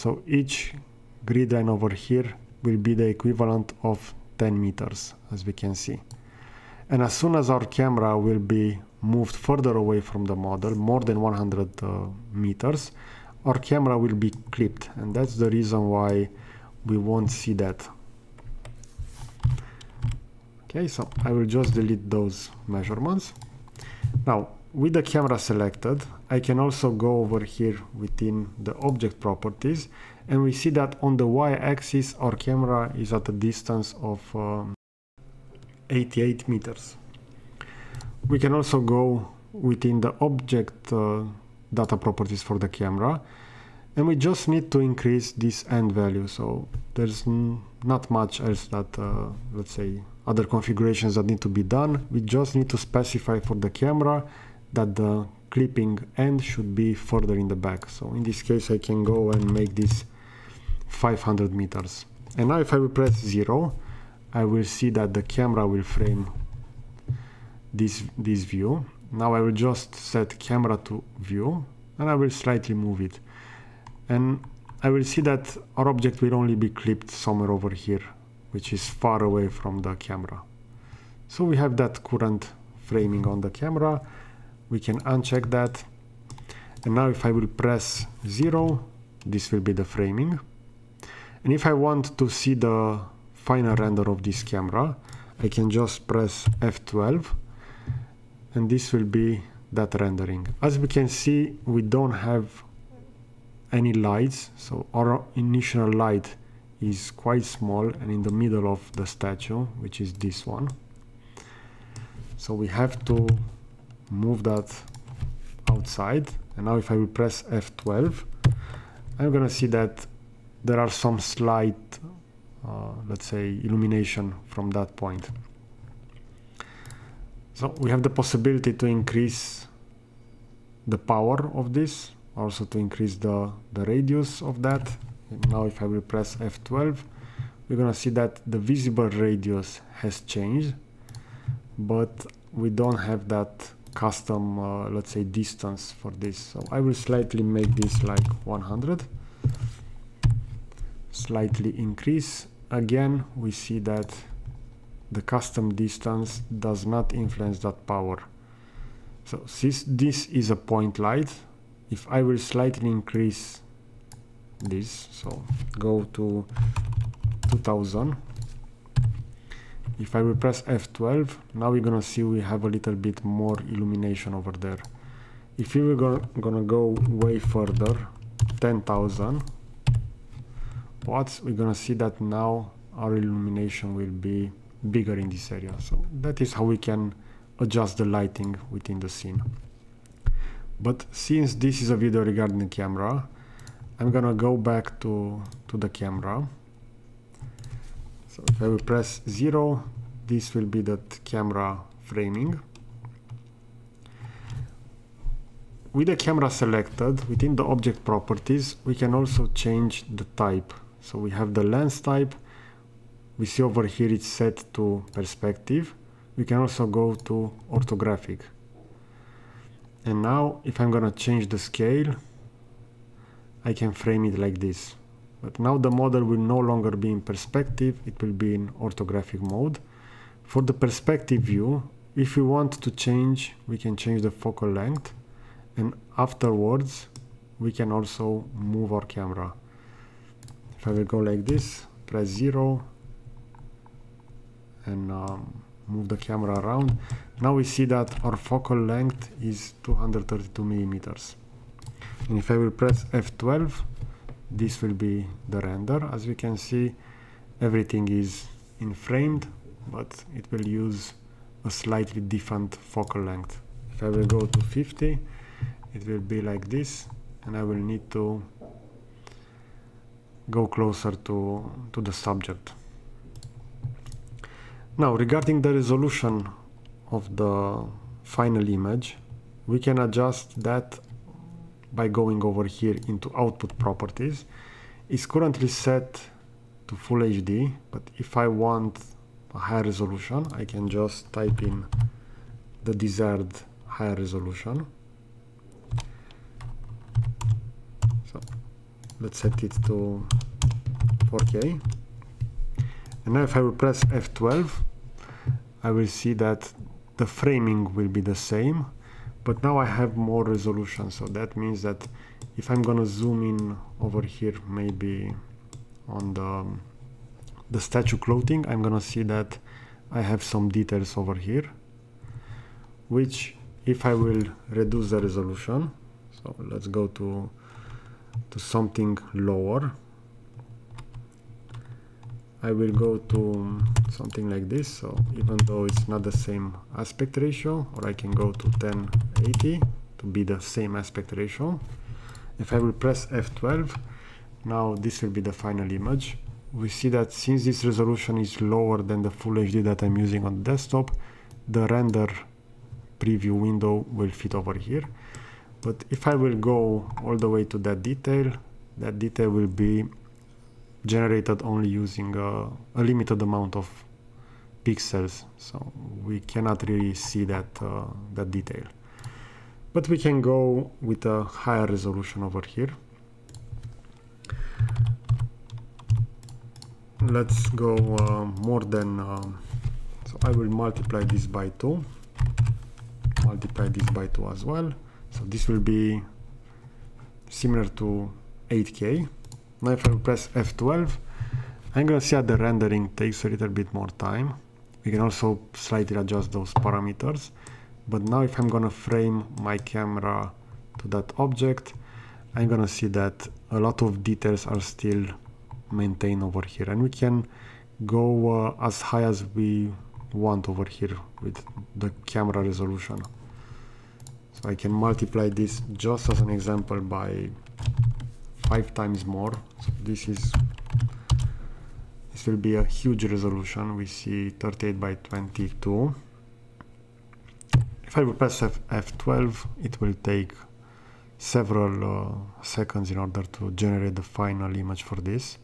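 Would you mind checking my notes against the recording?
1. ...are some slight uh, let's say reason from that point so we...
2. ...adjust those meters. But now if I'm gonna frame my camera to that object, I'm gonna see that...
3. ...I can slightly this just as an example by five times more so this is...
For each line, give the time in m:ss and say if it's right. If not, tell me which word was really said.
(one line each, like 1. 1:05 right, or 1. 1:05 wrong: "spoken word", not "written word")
1. 2:00 wrong: "illumination", not "reason"
2. 6:36 wrong: "parameters", not "meters"
3. 6:54 wrong: "multiply", not "slightly".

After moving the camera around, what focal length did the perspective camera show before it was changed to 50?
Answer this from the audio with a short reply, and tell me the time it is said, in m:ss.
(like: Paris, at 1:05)
232 millimeters, at 4:09.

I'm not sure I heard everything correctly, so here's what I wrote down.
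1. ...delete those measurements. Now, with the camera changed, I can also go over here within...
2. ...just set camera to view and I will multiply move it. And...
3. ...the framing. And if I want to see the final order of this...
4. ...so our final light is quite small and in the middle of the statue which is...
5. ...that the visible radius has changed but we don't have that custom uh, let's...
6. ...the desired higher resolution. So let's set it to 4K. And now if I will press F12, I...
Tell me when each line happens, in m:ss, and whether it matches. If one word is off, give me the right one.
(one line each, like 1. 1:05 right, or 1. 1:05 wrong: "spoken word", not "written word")
1. 0:21 wrong: "selected", not "changed"
2. 1:09 wrong: "slightly", not "multiply"
3. 1:29 wrong: "render", not "order"
4. 1:44 wrong: "initial", not "final"
5. 2:18 right
6. 4:52 right.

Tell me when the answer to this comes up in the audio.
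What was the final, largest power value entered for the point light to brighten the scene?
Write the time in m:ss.
2:58.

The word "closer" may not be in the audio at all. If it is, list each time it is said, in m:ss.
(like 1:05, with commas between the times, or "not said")
4:30.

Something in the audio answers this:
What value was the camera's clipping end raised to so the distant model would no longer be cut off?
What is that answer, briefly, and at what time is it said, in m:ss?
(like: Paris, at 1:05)
500 meters, at 1:00.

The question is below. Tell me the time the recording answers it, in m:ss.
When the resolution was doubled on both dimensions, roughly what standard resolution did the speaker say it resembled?
6:28.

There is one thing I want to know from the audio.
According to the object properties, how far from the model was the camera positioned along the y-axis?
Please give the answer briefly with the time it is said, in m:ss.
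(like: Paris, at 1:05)
88 meters, at 0:35.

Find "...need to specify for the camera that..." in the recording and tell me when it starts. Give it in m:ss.
0:52.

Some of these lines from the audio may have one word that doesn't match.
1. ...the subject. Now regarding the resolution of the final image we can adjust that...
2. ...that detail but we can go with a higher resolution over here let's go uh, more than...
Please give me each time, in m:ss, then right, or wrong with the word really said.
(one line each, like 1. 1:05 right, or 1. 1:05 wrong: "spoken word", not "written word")
1. 4:32 right
2. 6:08 right.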